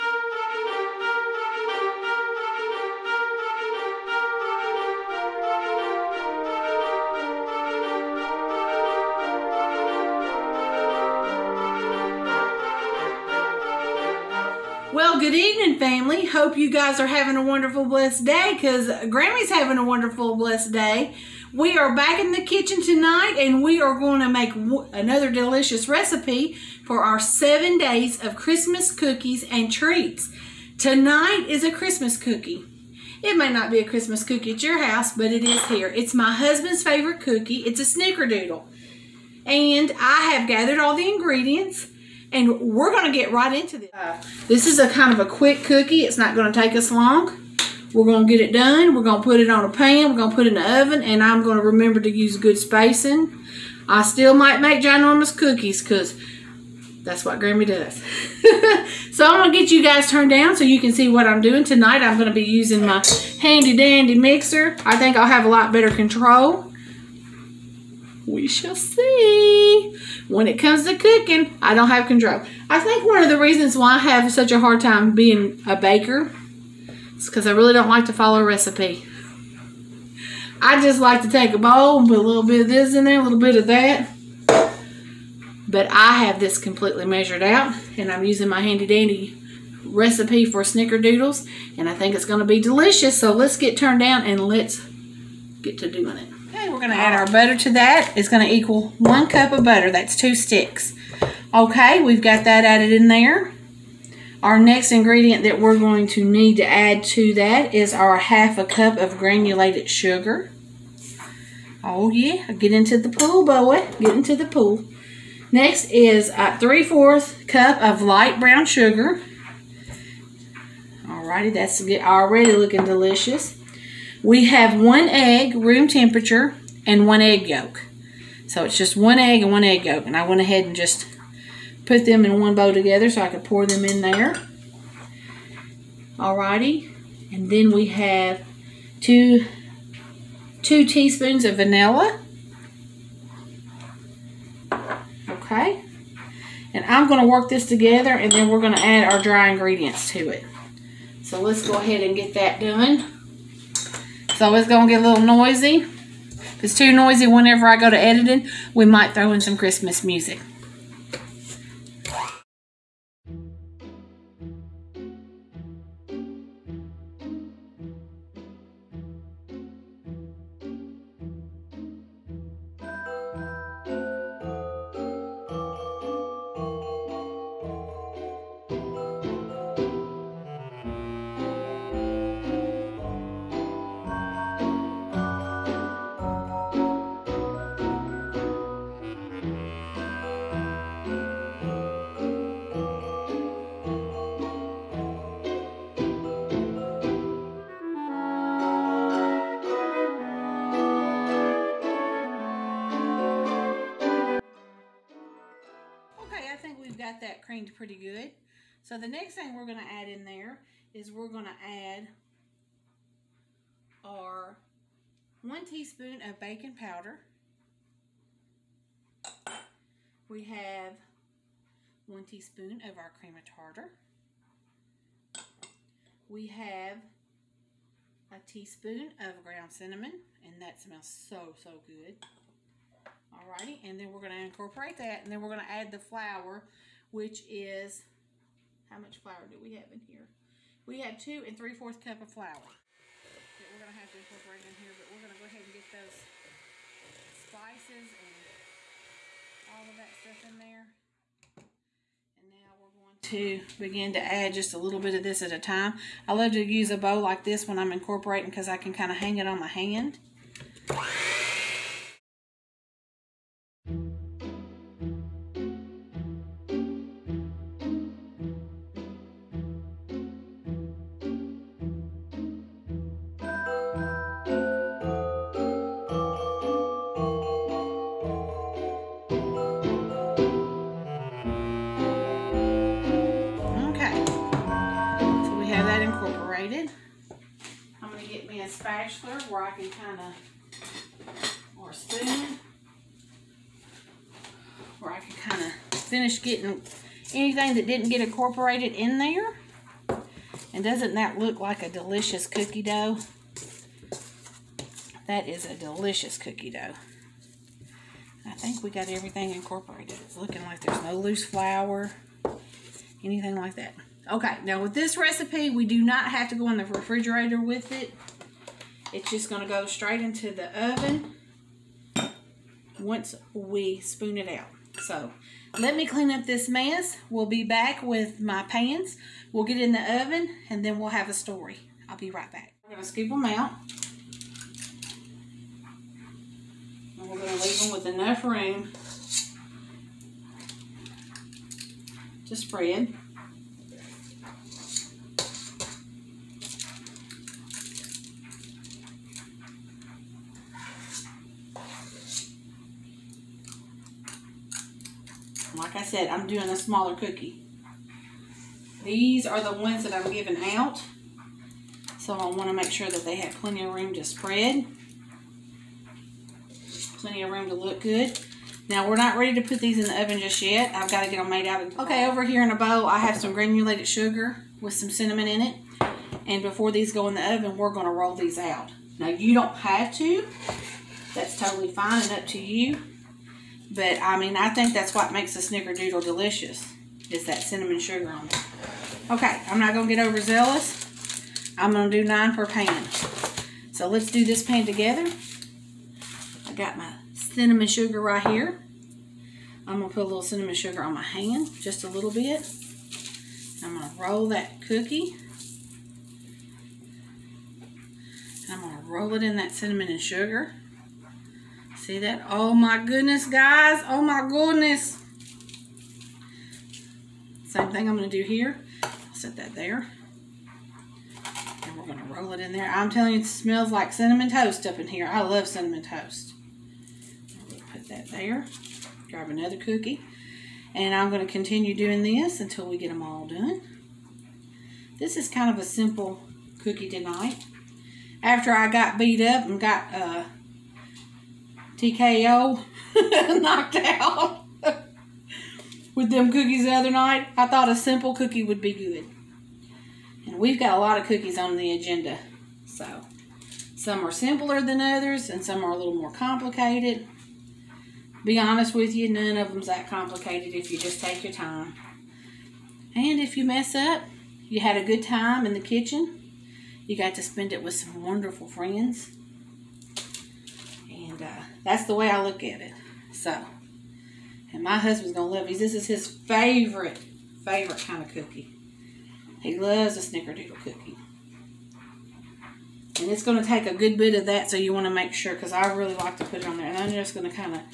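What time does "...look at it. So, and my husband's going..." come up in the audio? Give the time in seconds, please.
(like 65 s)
472 s.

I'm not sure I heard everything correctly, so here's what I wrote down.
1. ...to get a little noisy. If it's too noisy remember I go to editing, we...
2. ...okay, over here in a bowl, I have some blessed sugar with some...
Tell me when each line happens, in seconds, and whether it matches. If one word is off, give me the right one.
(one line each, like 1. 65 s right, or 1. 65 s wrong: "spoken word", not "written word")
1. 154 s wrong: "whenever", not "remember"
2. 372 s wrong: "granulated", not "blessed".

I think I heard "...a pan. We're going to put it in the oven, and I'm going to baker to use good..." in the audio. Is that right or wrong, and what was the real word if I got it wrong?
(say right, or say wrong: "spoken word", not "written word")
wrong: "remember", not "baker".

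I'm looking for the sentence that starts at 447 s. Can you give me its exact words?
I thought a simple cookie would be good.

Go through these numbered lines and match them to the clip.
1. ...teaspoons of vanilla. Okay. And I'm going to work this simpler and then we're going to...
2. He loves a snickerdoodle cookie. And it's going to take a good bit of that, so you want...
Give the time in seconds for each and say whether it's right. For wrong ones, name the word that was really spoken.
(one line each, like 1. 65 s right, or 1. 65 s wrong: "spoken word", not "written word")
1. 140 s wrong: "together", not "simpler"
2. 479 s right.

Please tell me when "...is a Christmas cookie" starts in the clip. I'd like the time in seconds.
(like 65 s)
31 s.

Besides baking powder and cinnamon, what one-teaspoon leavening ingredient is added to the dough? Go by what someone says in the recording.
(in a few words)
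Cream of tartar.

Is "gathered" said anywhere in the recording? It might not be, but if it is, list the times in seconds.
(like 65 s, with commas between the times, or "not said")
40 s.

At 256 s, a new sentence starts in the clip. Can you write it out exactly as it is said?
I love to use a bow like this when I'm incorporating because I can kind of hang it on my hand.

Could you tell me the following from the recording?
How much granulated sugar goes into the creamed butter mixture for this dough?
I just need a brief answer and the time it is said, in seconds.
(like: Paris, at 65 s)
1/2 cup, at 108 s.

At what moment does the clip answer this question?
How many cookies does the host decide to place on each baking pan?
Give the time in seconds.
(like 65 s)
392 s.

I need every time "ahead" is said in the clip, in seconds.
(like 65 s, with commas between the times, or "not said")
130 s, 151 s, 245 s.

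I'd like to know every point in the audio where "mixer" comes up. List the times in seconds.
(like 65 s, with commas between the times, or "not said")
64 s.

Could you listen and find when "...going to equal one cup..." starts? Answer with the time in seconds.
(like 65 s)
98 s.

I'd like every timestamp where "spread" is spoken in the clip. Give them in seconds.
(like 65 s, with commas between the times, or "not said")
342 s, 364 s.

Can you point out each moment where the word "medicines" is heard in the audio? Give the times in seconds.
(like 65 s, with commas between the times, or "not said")
not said.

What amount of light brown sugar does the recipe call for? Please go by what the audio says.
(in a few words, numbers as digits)
3/4 cup.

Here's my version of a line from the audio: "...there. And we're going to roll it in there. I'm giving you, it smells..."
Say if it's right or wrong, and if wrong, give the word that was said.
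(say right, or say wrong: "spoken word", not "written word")
wrong: "telling", not "giving".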